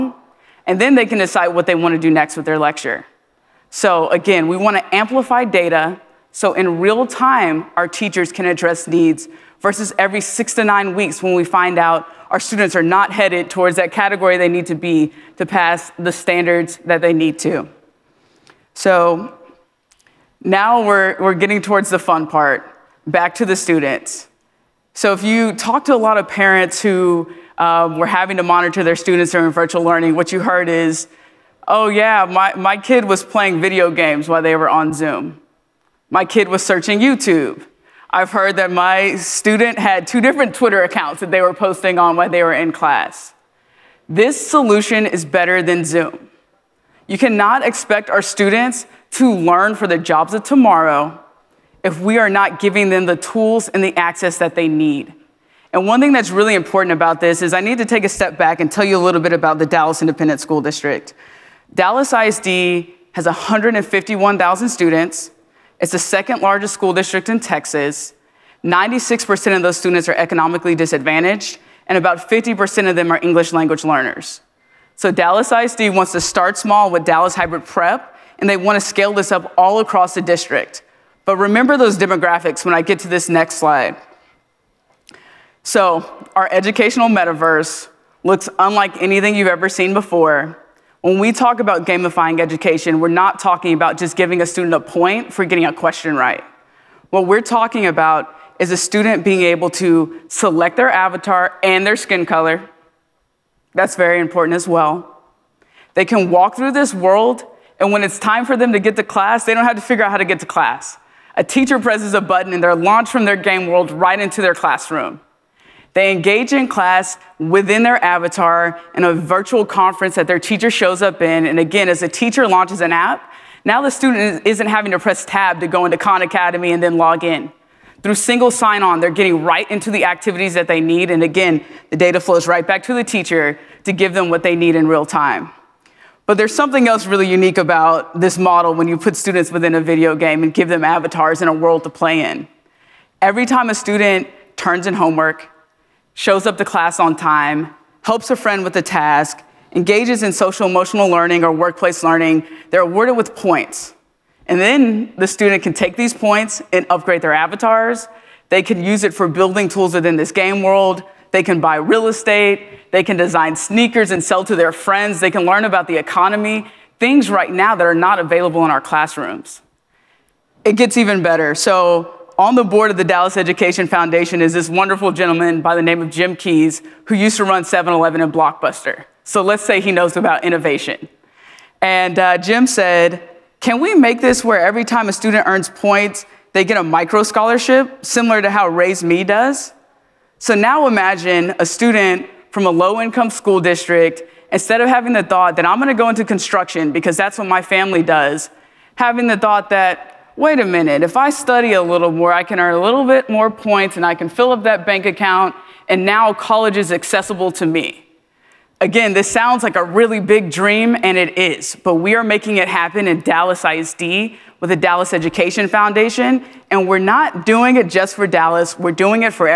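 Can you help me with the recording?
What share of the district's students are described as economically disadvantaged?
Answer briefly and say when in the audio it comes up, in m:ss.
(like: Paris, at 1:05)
96%, at 1:08.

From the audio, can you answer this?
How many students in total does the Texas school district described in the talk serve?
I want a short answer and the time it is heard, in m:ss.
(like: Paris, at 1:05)
151,000, at 1:03.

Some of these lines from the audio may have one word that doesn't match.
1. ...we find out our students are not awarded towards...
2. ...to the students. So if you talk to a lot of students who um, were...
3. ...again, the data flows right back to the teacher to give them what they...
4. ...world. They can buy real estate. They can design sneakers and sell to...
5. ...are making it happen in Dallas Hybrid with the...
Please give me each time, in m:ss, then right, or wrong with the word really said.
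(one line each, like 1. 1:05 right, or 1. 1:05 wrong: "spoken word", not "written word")
1. 0:11 wrong: "headed", not "awarded"
2. 0:23 wrong: "parents", not "students"
3. 2:11 right
4. 2:40 right
5. 3:32 wrong: "ISD", not "Hybrid".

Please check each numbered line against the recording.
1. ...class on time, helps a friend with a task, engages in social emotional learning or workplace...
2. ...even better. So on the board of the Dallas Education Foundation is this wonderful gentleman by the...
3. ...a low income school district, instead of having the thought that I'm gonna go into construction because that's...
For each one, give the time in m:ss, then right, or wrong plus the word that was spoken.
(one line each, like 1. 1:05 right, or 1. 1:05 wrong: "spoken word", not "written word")
1. 2:26 right
2. 2:50 right
3. 3:12 right.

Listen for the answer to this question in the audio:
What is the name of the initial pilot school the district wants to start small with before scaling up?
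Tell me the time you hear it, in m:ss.
1:17.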